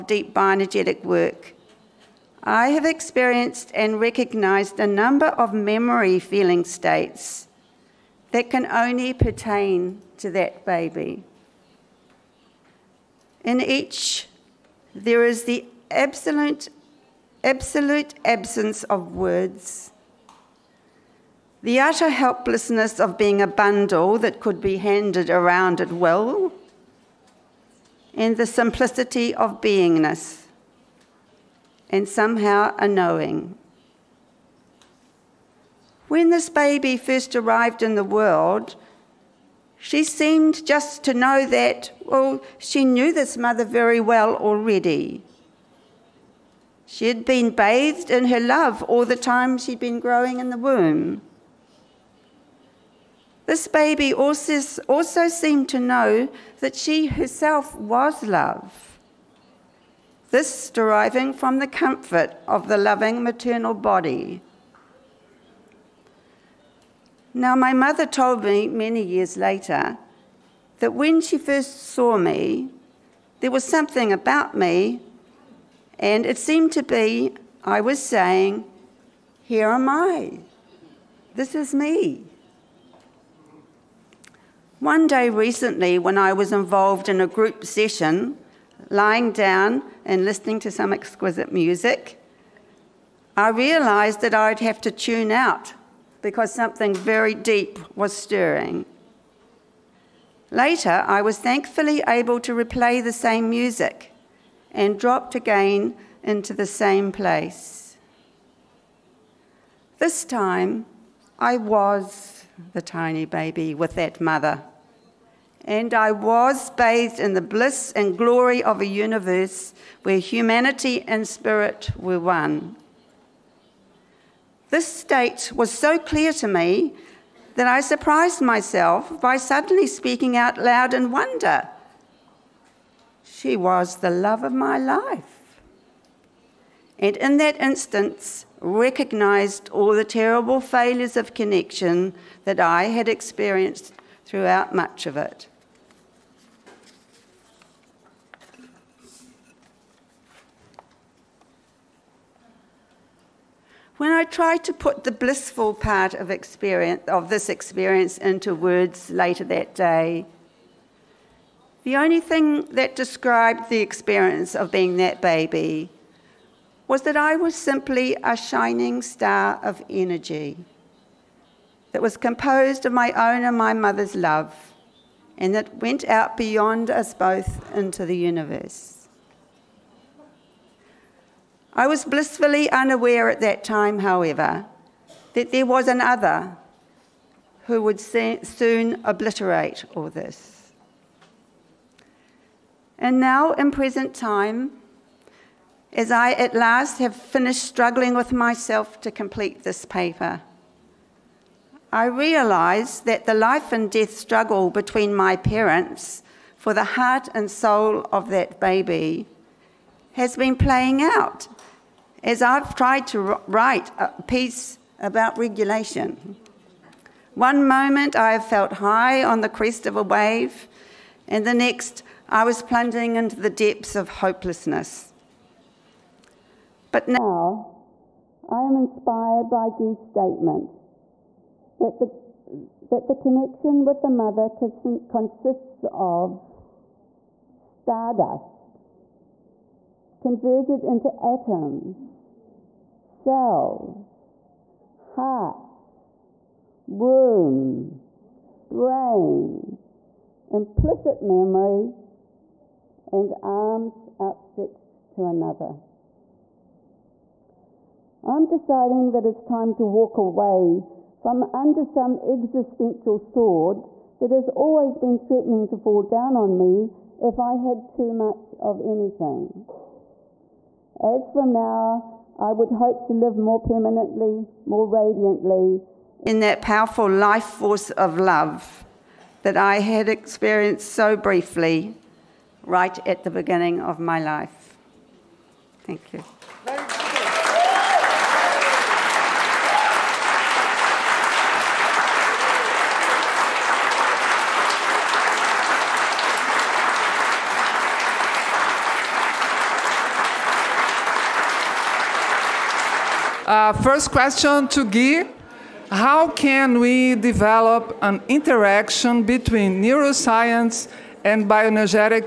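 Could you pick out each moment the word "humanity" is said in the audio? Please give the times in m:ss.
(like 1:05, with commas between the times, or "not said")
2:00.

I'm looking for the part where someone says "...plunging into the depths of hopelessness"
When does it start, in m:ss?
3:42.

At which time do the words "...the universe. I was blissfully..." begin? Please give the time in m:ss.
2:58.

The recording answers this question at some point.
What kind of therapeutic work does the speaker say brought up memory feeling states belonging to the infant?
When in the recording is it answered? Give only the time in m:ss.
0:00.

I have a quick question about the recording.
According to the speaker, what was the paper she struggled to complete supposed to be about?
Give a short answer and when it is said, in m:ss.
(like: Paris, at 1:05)
regulation, at 3:35.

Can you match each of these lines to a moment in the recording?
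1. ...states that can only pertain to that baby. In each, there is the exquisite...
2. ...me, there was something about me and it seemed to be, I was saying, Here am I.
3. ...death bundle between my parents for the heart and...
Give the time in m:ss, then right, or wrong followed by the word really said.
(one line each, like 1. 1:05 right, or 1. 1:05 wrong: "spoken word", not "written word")
1. 0:06 wrong: "absolute", not "exquisite"
2. 1:12 right
3. 3:23 wrong: "struggle", not "bundle".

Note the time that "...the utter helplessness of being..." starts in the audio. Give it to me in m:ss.
0:21.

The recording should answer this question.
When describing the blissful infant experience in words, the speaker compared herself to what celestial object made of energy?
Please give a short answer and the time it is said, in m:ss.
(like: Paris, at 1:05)
a shining star, at 2:48.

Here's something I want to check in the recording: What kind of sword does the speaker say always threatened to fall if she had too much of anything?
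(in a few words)
existential.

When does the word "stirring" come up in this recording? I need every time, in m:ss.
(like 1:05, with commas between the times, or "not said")
1:38.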